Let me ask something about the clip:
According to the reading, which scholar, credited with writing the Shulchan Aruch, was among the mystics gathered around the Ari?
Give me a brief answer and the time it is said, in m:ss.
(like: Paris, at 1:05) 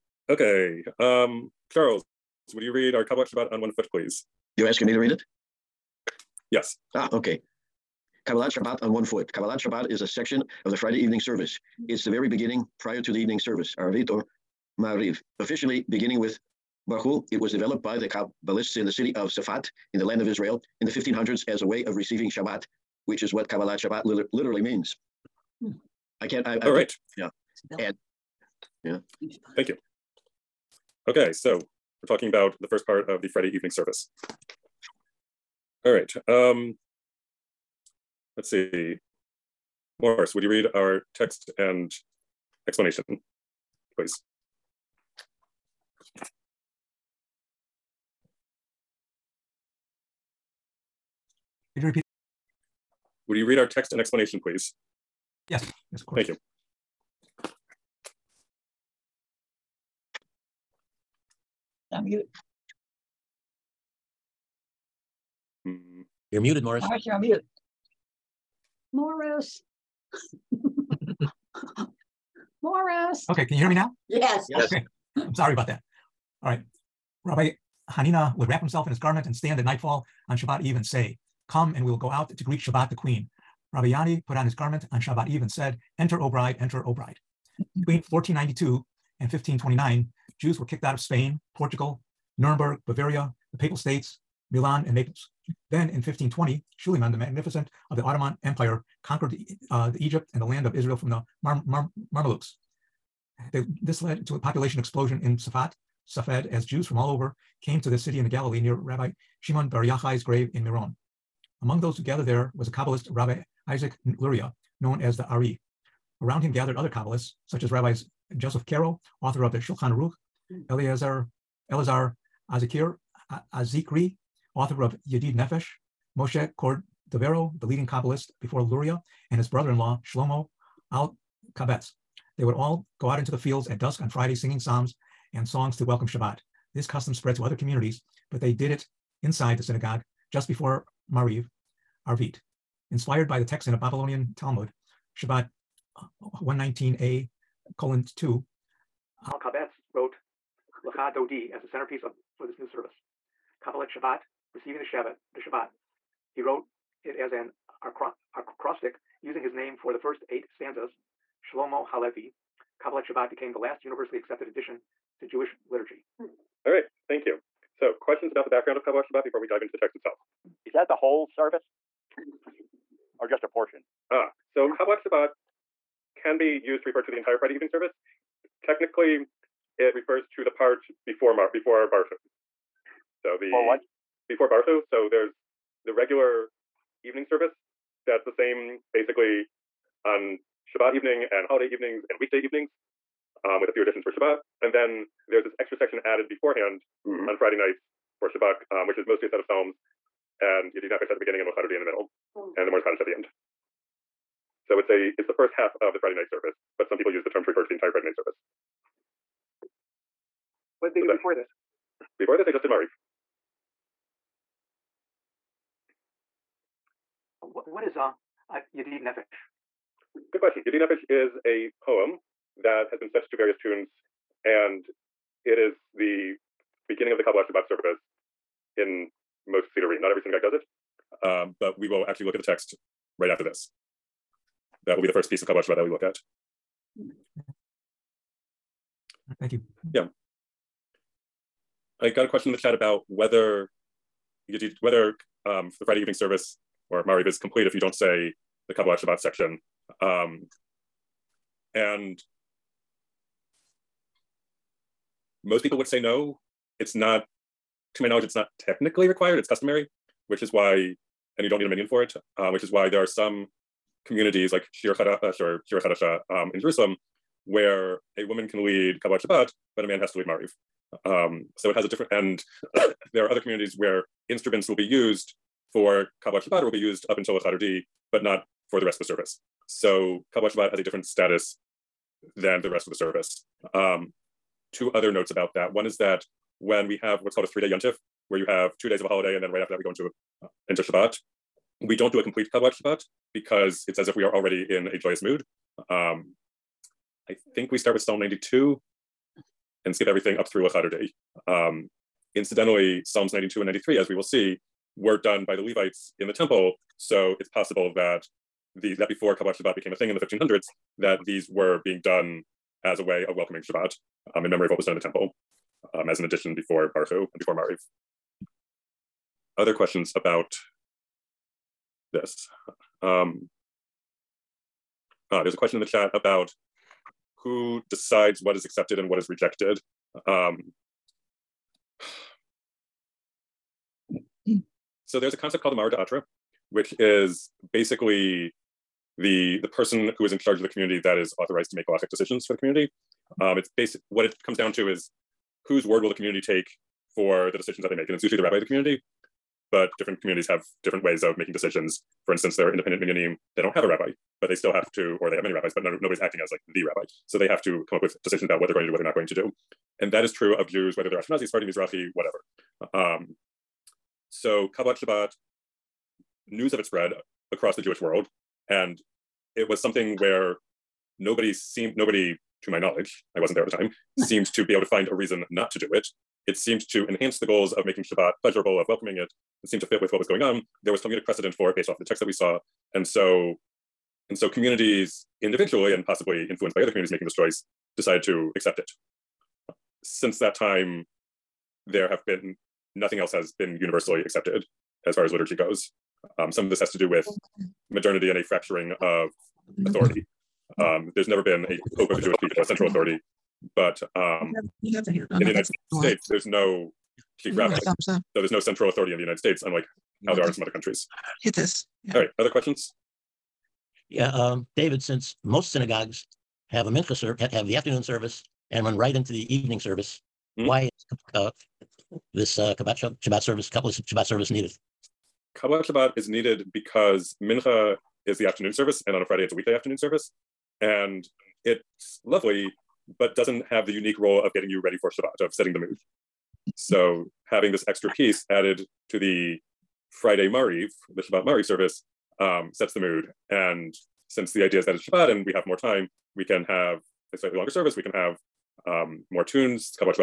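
Joseph Caro, at 1:58.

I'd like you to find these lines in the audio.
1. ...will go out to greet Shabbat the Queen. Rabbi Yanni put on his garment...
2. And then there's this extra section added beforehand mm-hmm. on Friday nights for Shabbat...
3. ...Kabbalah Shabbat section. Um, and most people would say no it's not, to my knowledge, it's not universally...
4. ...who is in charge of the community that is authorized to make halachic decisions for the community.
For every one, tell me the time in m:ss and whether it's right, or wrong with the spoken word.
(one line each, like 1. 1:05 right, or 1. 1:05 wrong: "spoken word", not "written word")
1. 1:21 right
2. 3:14 right
3. 4:08 wrong: "technically", not "universally"
4. 5:40 right.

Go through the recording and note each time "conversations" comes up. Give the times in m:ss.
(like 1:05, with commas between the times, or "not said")
not said.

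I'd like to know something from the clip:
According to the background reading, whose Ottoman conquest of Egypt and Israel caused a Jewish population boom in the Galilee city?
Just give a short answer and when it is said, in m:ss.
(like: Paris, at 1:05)
Suleiman the Magnificent, at 1:36.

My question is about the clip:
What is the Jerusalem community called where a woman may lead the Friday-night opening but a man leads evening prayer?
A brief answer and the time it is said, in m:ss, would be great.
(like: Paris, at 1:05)
Shir Hadasha, at 4:25.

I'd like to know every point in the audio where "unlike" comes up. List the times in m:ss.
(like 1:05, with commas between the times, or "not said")
6:49.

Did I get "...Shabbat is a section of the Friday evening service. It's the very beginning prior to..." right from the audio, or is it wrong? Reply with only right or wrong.
right.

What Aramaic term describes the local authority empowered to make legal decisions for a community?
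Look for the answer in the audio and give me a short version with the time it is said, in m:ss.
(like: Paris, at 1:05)
Mara de Atra, at 5:35.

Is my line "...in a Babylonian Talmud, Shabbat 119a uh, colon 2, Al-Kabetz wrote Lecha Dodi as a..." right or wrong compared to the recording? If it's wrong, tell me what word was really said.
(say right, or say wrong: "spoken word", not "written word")
right.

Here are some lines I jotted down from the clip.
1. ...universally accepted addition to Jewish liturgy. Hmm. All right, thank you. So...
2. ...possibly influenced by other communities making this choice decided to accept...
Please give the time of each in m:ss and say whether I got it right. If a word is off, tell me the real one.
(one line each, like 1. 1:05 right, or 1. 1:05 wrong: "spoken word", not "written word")
1. 2:43 right
2. 6:26 right.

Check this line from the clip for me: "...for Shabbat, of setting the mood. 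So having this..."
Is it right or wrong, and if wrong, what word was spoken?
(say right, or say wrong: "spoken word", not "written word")
right.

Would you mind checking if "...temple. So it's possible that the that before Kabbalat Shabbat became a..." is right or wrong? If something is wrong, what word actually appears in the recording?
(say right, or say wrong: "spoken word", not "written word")
right.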